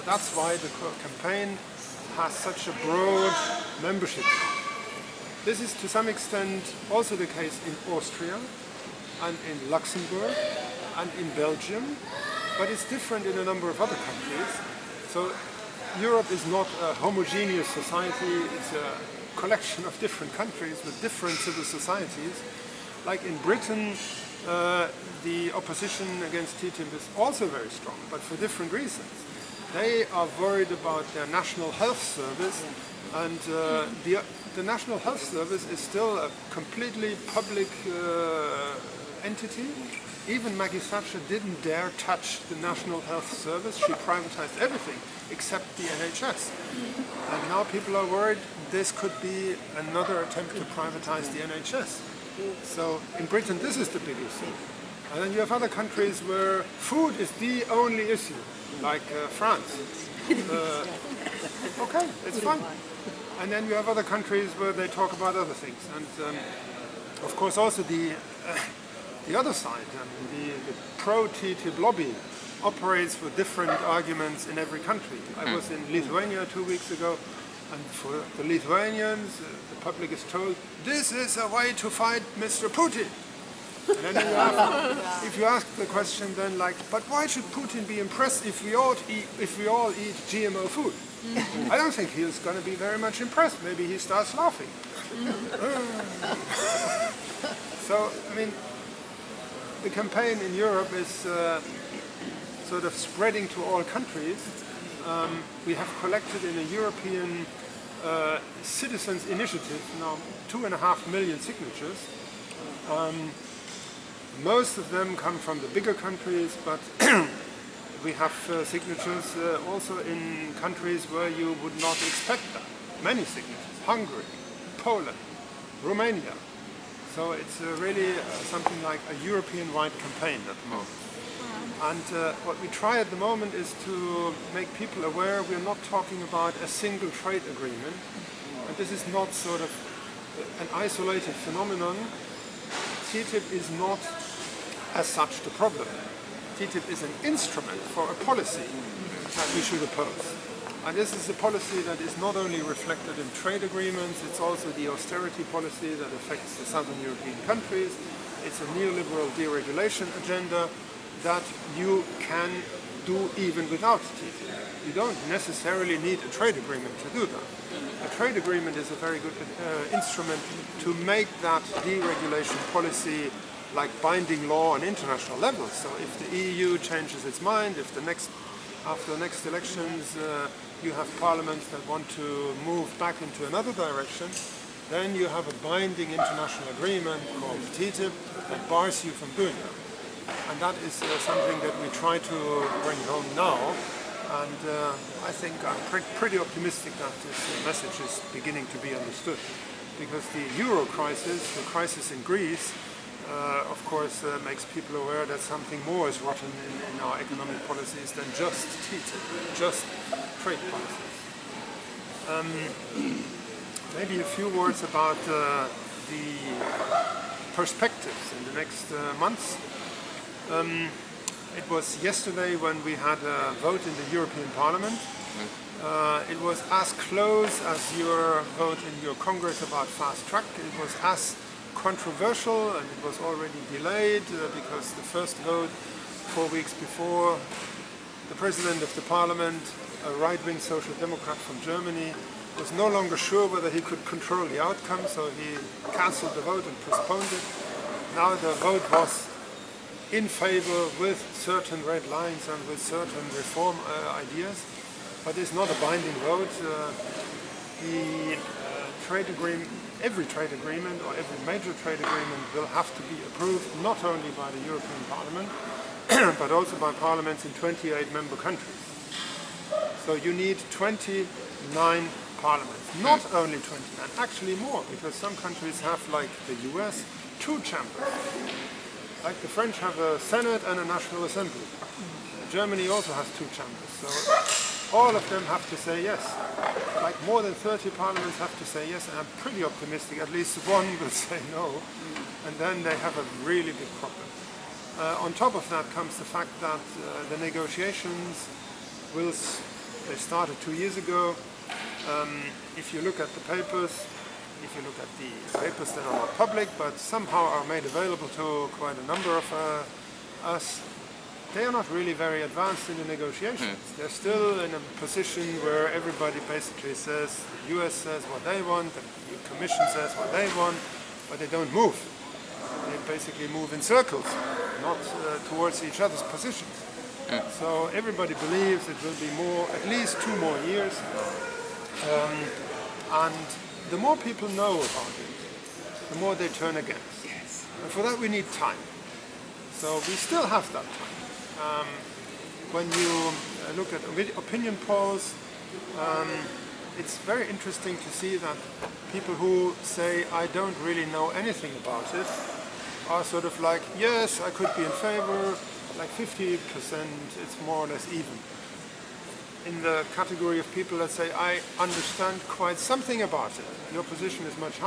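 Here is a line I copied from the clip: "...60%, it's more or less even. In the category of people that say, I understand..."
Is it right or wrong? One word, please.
wrong.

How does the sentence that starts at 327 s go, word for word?
So everybody believes it will be more, at least two more years.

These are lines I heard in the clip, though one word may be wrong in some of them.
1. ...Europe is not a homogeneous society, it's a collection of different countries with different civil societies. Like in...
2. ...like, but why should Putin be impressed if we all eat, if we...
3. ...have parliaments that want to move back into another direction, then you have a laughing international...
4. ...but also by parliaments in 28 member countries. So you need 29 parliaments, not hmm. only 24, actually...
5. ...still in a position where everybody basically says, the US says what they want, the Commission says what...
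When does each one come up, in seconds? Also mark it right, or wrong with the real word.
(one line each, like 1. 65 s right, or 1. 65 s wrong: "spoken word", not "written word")
1. 15 s right
2. 86 s right
3. 180 s wrong: "binding", not "laughing"
4. 266 s wrong: "29", not "24"
5. 314 s right.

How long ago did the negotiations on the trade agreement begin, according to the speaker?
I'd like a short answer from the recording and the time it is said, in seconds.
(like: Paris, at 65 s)
2 years ago, at 300 s.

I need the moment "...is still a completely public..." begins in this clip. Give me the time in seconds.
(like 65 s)
35 s.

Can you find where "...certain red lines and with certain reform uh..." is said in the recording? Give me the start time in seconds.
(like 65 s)
251 s.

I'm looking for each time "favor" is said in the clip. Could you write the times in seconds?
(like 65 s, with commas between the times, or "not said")
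250 s, 354 s.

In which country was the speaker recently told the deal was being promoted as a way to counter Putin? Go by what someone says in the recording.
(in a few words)
Lithuania.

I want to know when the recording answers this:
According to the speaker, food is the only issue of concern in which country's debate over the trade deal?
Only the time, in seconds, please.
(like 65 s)
59 s.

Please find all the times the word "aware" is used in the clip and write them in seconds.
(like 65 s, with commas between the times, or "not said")
135 s, 205 s.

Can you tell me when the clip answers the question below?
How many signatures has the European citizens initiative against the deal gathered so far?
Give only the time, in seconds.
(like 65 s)
110 s.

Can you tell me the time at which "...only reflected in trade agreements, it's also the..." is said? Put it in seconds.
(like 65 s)
152 s.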